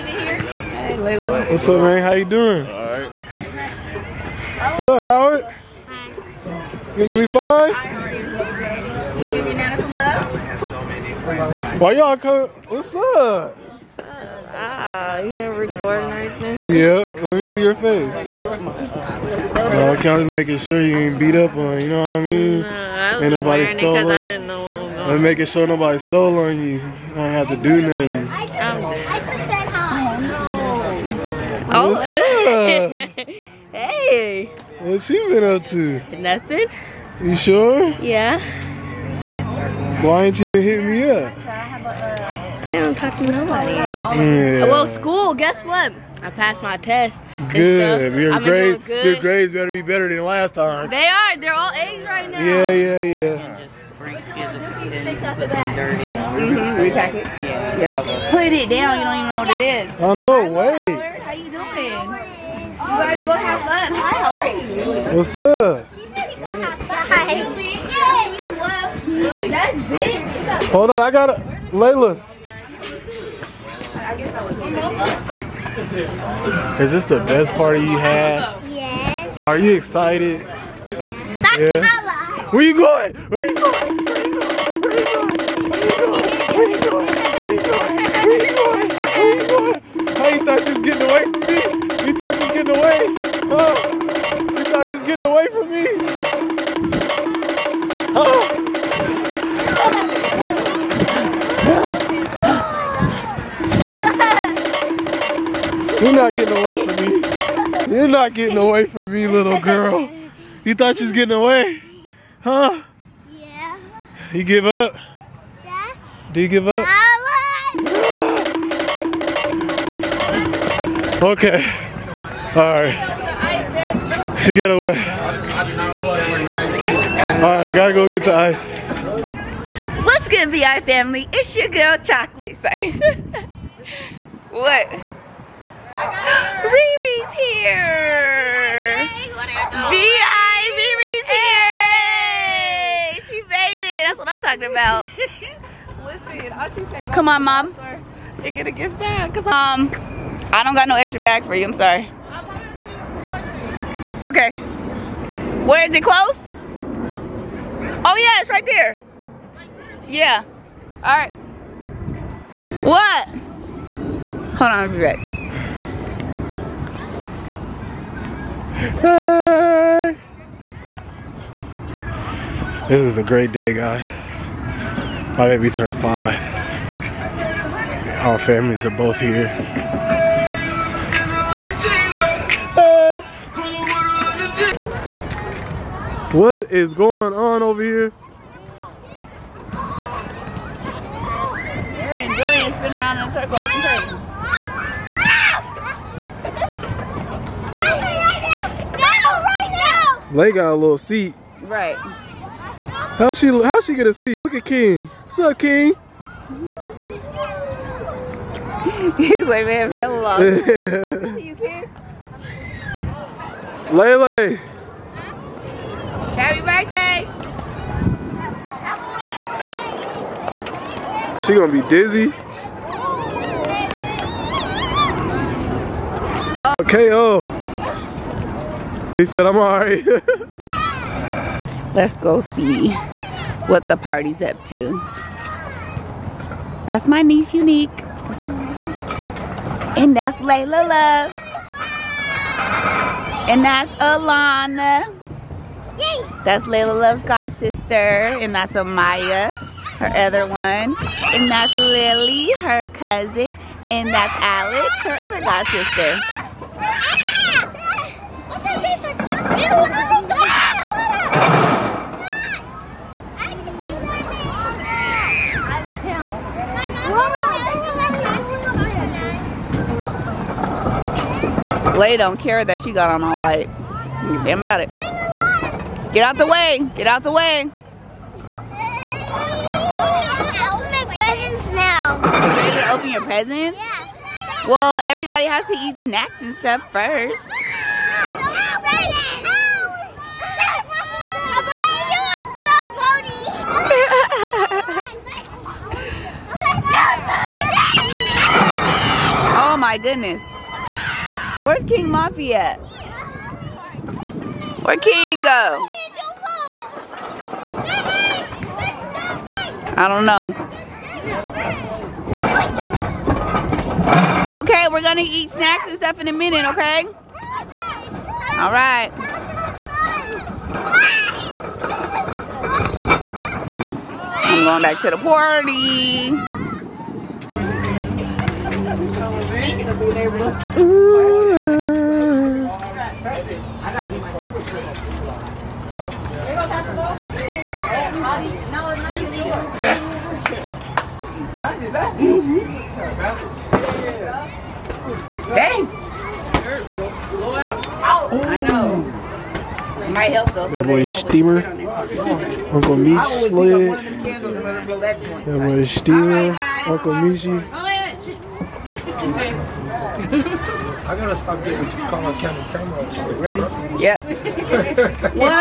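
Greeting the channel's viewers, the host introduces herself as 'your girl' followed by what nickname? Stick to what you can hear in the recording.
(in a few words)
Chocolate Say.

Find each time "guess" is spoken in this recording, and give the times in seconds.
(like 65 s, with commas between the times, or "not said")
45 s.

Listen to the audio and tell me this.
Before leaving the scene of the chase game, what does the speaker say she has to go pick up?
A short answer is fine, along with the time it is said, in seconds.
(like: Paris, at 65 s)
Ice, at 128 s.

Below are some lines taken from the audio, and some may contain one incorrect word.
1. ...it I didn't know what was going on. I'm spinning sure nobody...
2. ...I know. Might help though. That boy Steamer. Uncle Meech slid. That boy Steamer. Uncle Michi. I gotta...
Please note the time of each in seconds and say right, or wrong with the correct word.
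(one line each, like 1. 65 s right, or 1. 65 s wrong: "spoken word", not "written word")
1. 24 s wrong: "making", not "spinning"
2. 348 s right.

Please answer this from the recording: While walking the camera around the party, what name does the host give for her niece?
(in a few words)
Unique.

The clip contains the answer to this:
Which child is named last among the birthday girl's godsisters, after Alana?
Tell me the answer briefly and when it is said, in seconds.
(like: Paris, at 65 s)
Alex, at 254 s.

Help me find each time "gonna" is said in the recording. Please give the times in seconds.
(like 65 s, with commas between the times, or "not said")
221 s, 315 s.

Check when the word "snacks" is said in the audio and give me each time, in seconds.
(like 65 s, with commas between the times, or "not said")
285 s, 315 s.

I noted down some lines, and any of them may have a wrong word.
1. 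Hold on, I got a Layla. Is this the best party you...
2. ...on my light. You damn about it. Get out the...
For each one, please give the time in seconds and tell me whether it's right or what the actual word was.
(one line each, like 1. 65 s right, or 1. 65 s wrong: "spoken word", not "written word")
1. 70 s right
2. 273 s right.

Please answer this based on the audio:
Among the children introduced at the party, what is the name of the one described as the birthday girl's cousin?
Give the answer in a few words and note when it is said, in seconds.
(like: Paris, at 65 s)
Lily, at 251 s.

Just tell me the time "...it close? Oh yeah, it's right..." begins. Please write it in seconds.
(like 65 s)
155 s.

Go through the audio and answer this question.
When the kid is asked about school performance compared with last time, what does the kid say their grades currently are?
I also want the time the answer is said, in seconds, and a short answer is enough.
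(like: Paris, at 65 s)
All A's, at 51 s.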